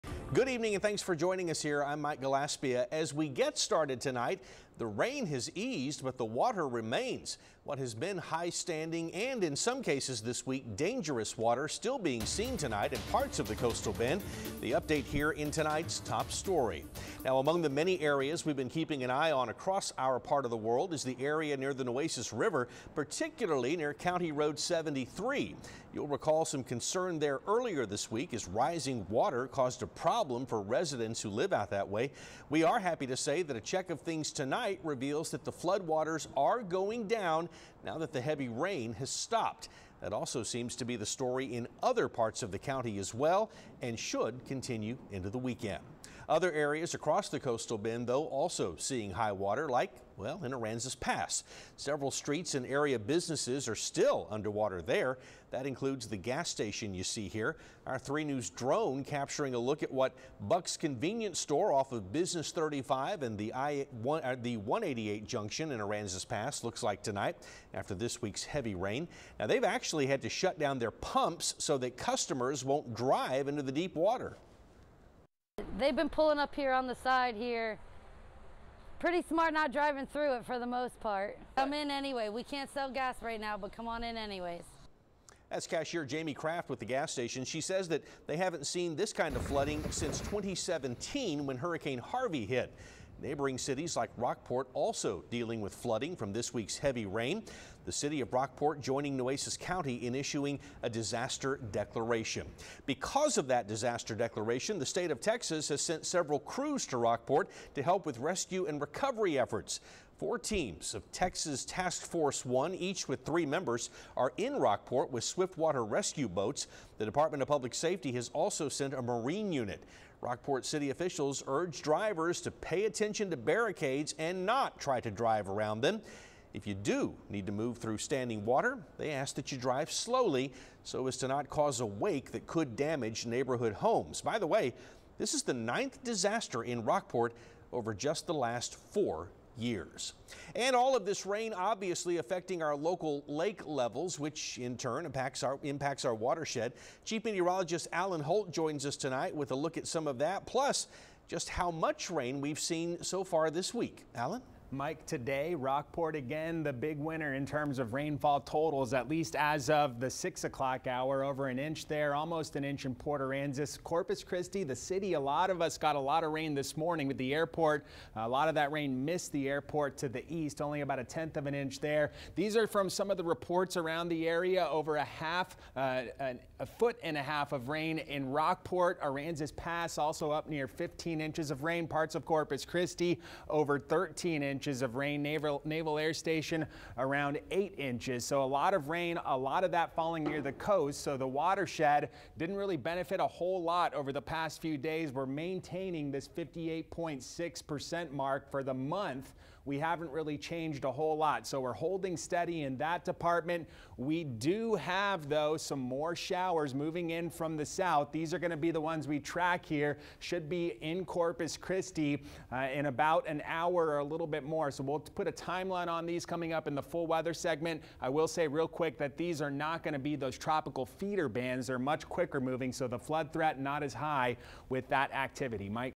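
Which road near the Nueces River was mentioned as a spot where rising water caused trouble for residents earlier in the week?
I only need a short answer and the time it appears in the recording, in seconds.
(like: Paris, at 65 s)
County Road 73, at 23 s.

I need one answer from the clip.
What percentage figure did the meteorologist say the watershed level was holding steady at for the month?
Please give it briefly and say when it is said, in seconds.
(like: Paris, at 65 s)
58.6%, at 196 s.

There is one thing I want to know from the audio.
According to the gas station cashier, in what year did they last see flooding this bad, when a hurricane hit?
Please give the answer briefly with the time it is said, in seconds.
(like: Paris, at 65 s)
2017, at 90 s.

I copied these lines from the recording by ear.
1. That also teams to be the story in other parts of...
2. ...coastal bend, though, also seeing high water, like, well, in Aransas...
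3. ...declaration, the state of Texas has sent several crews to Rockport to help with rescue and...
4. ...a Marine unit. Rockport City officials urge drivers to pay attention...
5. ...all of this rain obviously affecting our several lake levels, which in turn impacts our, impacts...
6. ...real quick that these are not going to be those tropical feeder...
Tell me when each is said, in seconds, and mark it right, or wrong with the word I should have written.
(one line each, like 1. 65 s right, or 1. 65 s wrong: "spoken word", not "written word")
1. 40 s wrong: "seems", not "teams"
2. 47 s right
3. 104 s right
4. 118 s right
5. 140 s wrong: "local", not "several"
6. 218 s right.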